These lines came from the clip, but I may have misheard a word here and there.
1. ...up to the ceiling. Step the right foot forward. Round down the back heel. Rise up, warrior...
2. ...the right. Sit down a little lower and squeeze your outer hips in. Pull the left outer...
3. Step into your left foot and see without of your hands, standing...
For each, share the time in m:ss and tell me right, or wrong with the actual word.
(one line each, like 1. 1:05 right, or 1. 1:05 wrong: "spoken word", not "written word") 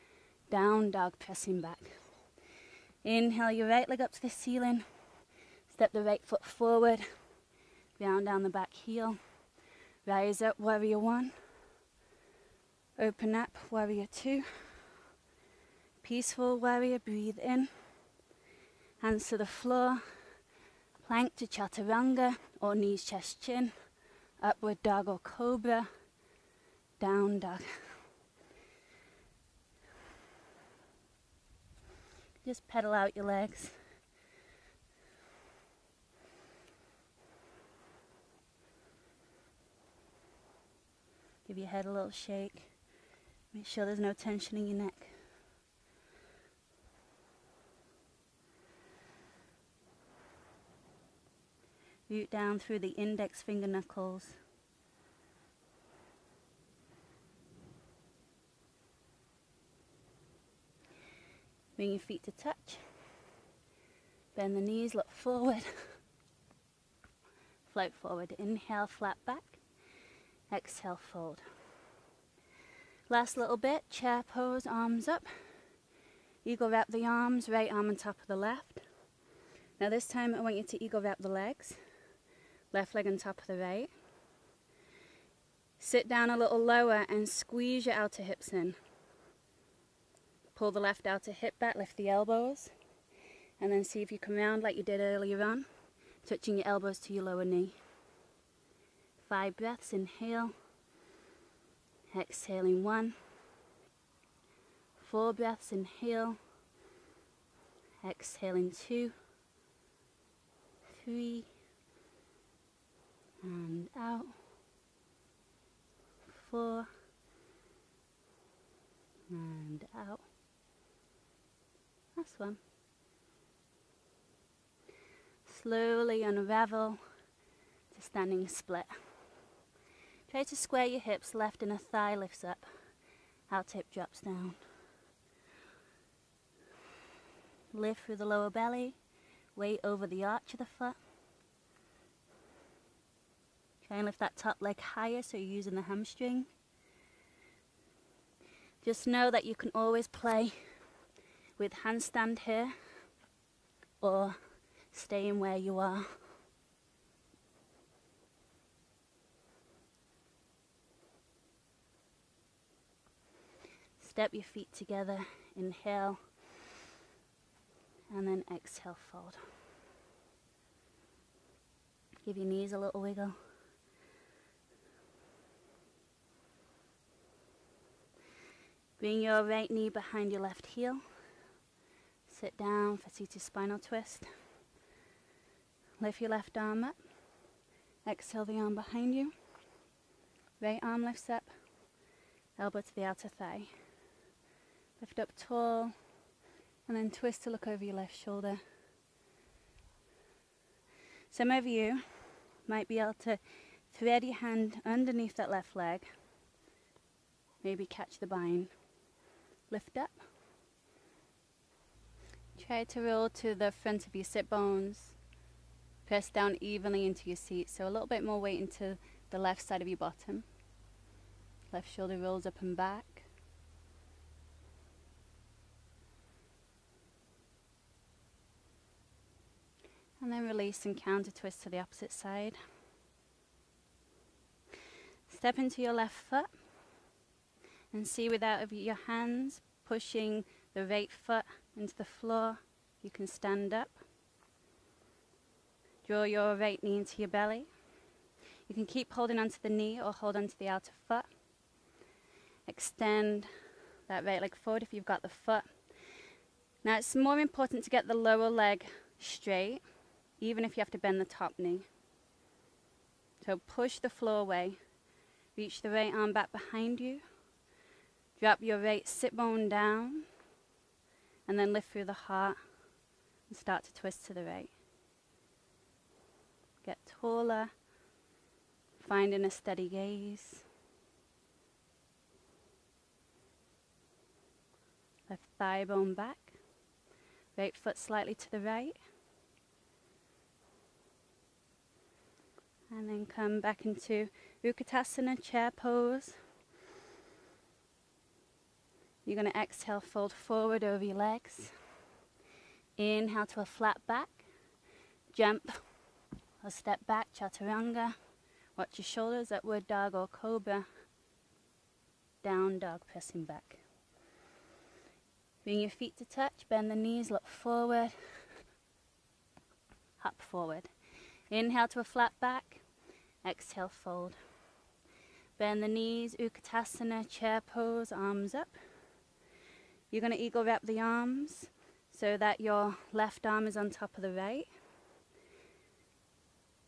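1. 0:04 right
2. 1:23 right
3. 3:55 wrong: "pushing", not "standing".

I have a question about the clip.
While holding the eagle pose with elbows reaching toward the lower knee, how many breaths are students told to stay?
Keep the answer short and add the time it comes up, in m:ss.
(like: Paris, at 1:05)
5, at 1:39.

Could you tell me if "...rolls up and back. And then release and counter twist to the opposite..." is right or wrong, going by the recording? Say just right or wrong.
right.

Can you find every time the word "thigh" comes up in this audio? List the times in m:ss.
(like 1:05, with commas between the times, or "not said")
2:11, 3:13, 4:45.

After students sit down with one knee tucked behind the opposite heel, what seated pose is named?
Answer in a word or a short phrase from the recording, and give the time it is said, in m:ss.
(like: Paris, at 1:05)
Seated spinal twist, at 3:03.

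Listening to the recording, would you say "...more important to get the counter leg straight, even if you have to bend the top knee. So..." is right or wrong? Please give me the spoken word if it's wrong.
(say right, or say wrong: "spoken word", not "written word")
wrong: "lower", not "counter".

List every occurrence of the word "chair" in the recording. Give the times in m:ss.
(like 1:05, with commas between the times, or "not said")
1:13, 4:55, 5:27.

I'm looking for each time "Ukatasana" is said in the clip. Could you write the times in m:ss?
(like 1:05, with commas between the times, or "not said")
4:54, 5:26.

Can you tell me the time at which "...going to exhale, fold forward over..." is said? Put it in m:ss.
4:59.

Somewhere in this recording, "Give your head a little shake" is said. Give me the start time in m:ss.
0:41.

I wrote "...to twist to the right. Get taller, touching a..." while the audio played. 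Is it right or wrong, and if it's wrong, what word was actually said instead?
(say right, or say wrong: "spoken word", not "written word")
wrong: "finding", not "touching".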